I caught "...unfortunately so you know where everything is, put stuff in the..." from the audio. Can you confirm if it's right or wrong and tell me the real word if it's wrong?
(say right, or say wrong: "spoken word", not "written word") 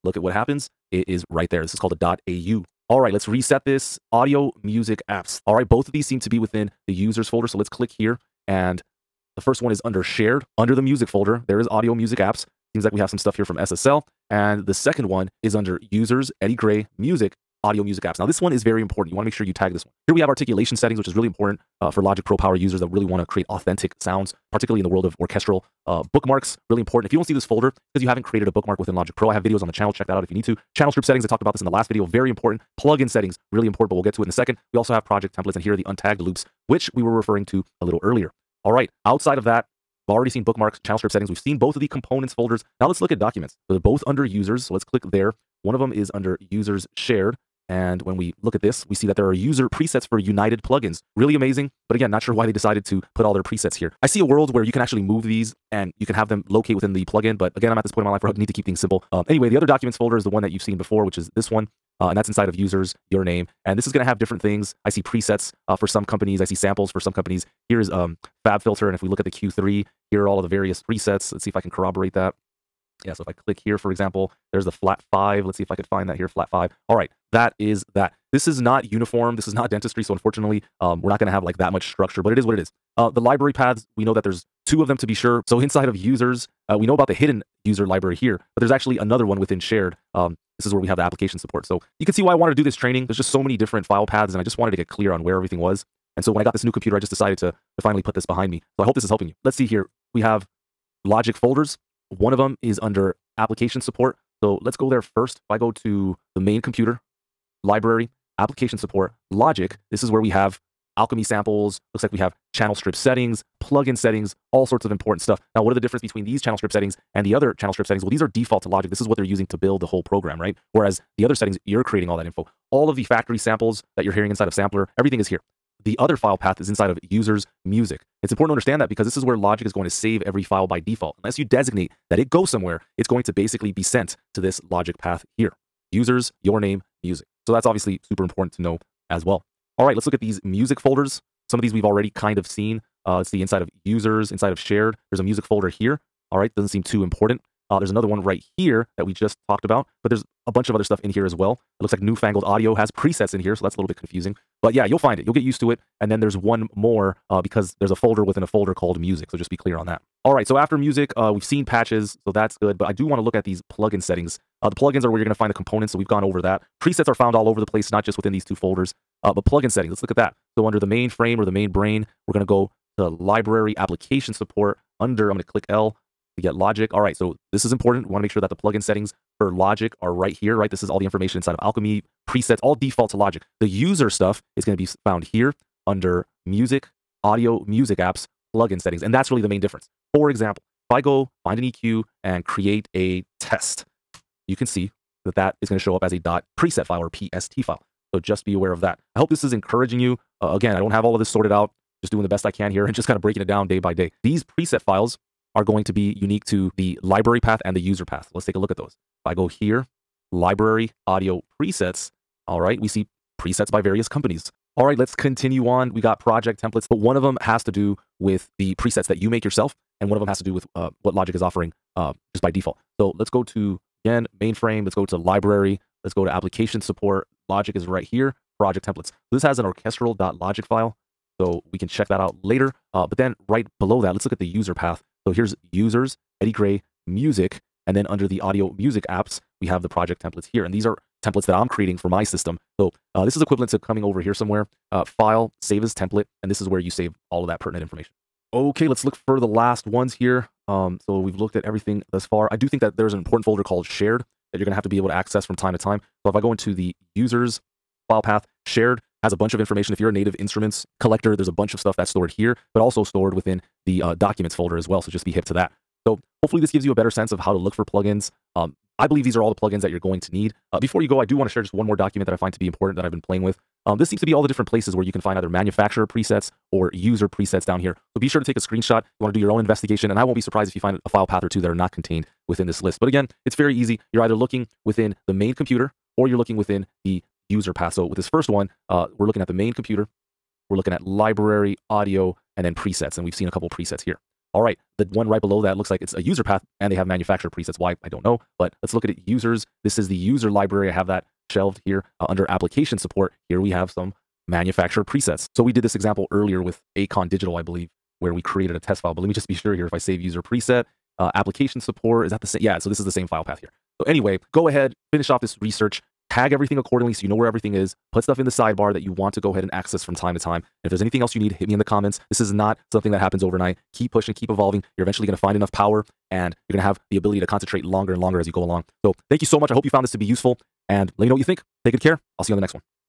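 wrong: "accordingly", not "unfortunately".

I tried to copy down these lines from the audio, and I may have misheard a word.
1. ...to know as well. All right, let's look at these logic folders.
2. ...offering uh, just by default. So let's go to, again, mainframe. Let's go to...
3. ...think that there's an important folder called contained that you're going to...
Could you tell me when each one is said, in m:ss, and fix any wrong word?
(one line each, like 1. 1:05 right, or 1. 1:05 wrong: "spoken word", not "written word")
1. 2:18 wrong: "music", not "logic"
2. 3:41 right
3. 4:12 wrong: "shared", not "contained".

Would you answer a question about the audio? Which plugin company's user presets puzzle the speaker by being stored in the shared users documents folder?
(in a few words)
United plugins.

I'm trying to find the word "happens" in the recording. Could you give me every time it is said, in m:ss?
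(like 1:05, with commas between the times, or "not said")
0:00, 5:23.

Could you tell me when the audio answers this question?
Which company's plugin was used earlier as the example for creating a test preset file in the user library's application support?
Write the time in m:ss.
5:06.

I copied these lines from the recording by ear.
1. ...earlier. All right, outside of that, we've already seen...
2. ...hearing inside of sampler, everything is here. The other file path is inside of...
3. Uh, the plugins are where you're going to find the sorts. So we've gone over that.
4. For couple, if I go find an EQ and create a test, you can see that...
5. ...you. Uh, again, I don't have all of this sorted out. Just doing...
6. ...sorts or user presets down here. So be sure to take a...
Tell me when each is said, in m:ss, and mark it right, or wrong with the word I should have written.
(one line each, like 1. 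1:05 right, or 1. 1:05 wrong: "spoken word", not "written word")
1. 0:38 right
2. 2:04 right
3. 2:44 wrong: "components", not "sorts"
4. 3:10 wrong: "example", not "couple"
5. 3:19 right
6. 4:36 wrong: "presets", not "sorts".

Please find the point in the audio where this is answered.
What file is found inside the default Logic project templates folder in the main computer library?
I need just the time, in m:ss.
3:49.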